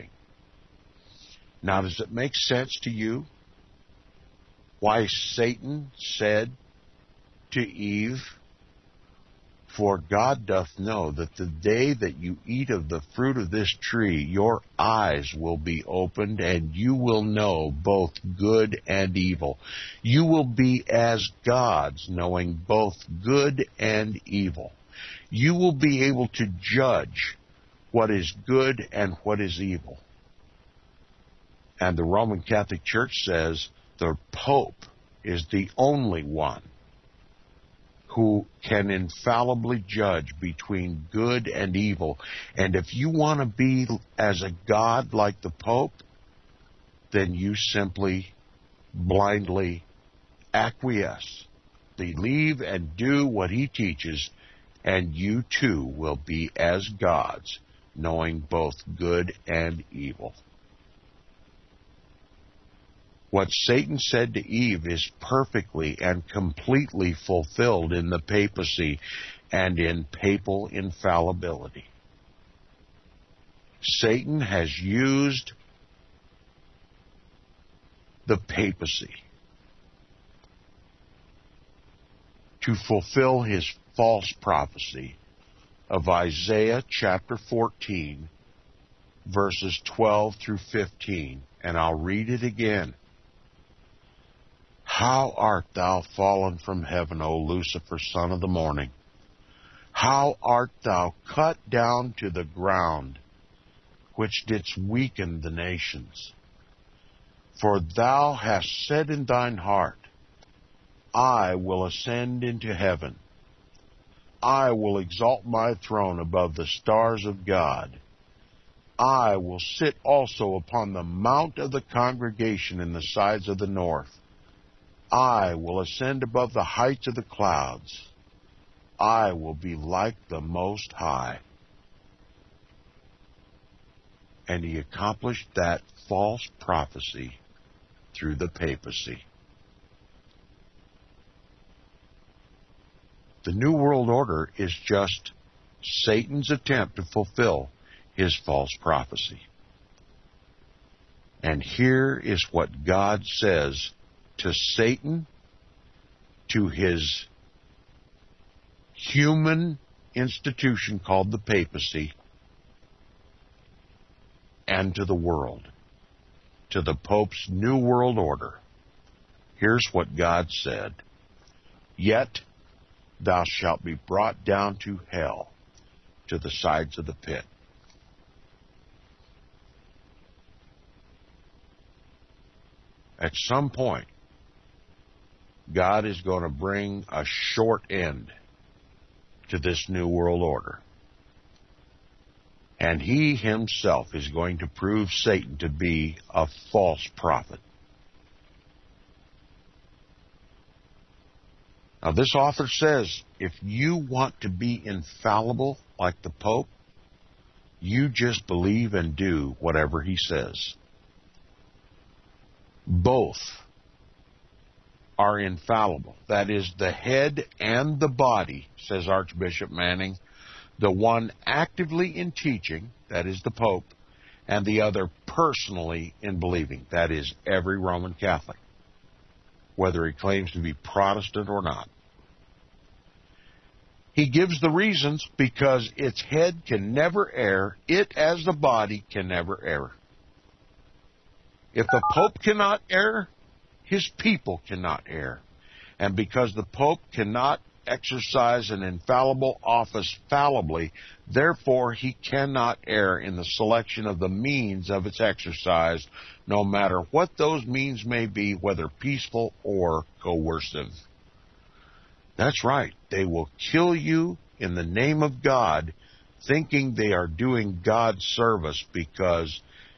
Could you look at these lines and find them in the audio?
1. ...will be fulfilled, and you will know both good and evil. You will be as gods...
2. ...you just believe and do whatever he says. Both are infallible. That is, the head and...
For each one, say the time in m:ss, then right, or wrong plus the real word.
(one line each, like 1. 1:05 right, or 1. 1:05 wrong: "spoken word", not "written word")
1. 0:15 wrong: "opened", not "fulfilled"
2. 3:27 right.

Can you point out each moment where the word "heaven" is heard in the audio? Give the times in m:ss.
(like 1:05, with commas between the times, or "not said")
1:36, 1:52.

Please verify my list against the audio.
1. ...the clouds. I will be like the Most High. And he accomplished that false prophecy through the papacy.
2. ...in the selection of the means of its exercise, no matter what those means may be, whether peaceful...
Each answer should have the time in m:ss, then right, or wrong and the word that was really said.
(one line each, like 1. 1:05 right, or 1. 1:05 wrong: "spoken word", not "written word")
1. 2:07 right
2. 4:13 right.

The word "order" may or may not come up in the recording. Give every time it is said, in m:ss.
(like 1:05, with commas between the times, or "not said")
2:24, 2:48, 3:10.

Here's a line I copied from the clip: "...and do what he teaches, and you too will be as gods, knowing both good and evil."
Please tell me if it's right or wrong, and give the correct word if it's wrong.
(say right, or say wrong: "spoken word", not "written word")
right.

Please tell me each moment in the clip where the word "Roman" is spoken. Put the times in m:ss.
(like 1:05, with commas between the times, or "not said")
0:32, 3:47.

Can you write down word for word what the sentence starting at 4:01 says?
If the Pope cannot err, his people cannot err.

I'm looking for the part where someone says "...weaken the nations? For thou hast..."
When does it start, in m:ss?
1:44.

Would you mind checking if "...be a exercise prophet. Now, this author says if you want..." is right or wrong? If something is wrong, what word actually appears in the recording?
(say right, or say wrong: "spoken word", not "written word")
wrong: "false", not "exercise".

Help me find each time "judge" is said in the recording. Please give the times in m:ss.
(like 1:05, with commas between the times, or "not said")
0:26, 0:39.